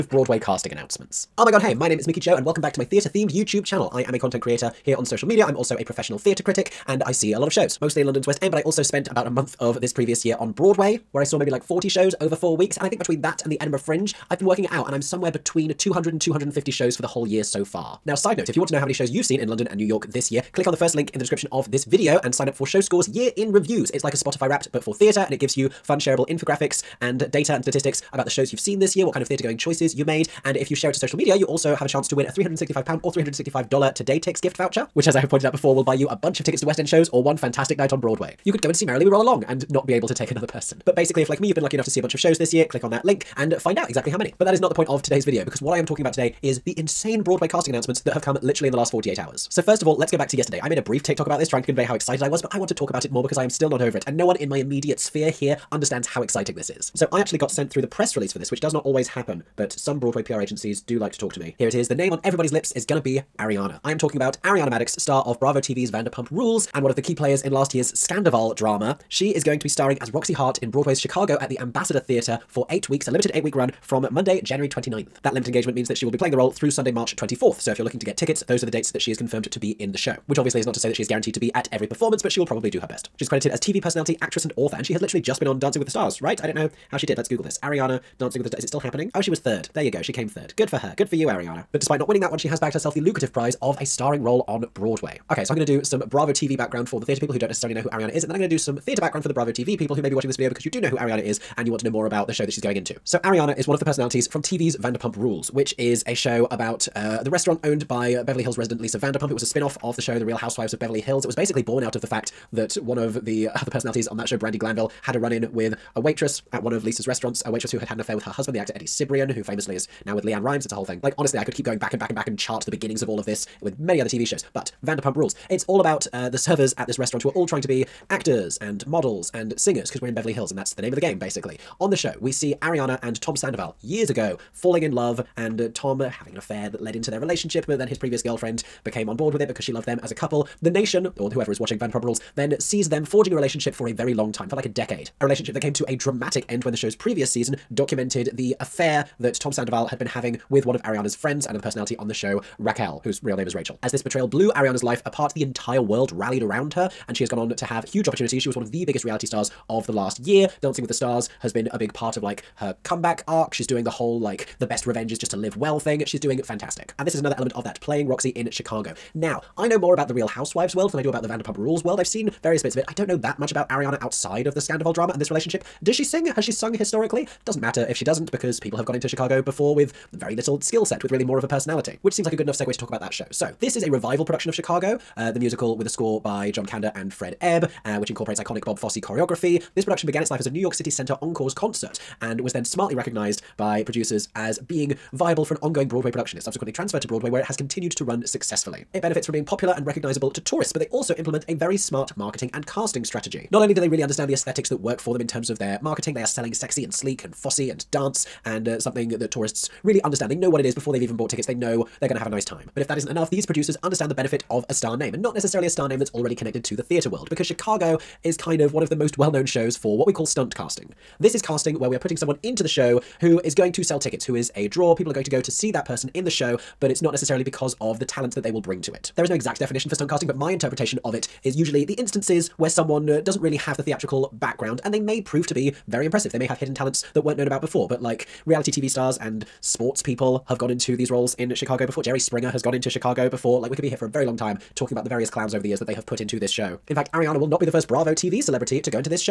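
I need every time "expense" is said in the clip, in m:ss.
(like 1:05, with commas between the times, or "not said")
not said.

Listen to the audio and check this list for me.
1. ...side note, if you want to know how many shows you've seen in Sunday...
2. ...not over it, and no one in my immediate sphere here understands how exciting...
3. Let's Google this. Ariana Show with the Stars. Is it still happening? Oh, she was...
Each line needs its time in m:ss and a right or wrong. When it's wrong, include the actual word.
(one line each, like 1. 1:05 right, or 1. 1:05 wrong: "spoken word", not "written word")
1. 0:18 wrong: "London", not "Sunday"
2. 0:53 right
3. 1:27 wrong: "Dancing", not "Show".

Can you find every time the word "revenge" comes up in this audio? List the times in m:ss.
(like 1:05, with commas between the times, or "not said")
2:44.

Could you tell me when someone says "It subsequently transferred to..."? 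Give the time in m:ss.
3:16.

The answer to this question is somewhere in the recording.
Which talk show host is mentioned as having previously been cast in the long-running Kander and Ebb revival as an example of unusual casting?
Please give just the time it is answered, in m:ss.
4:02.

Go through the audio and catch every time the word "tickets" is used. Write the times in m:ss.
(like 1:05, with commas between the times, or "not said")
0:36, 1:18, 3:31, 3:43.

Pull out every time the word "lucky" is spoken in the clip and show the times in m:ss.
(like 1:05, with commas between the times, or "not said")
0:41.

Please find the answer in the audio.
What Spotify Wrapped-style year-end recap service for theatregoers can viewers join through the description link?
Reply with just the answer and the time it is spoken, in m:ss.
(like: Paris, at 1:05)
Show Score, at 0:22.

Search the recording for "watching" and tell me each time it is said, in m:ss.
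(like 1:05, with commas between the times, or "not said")
1:40, 2:21.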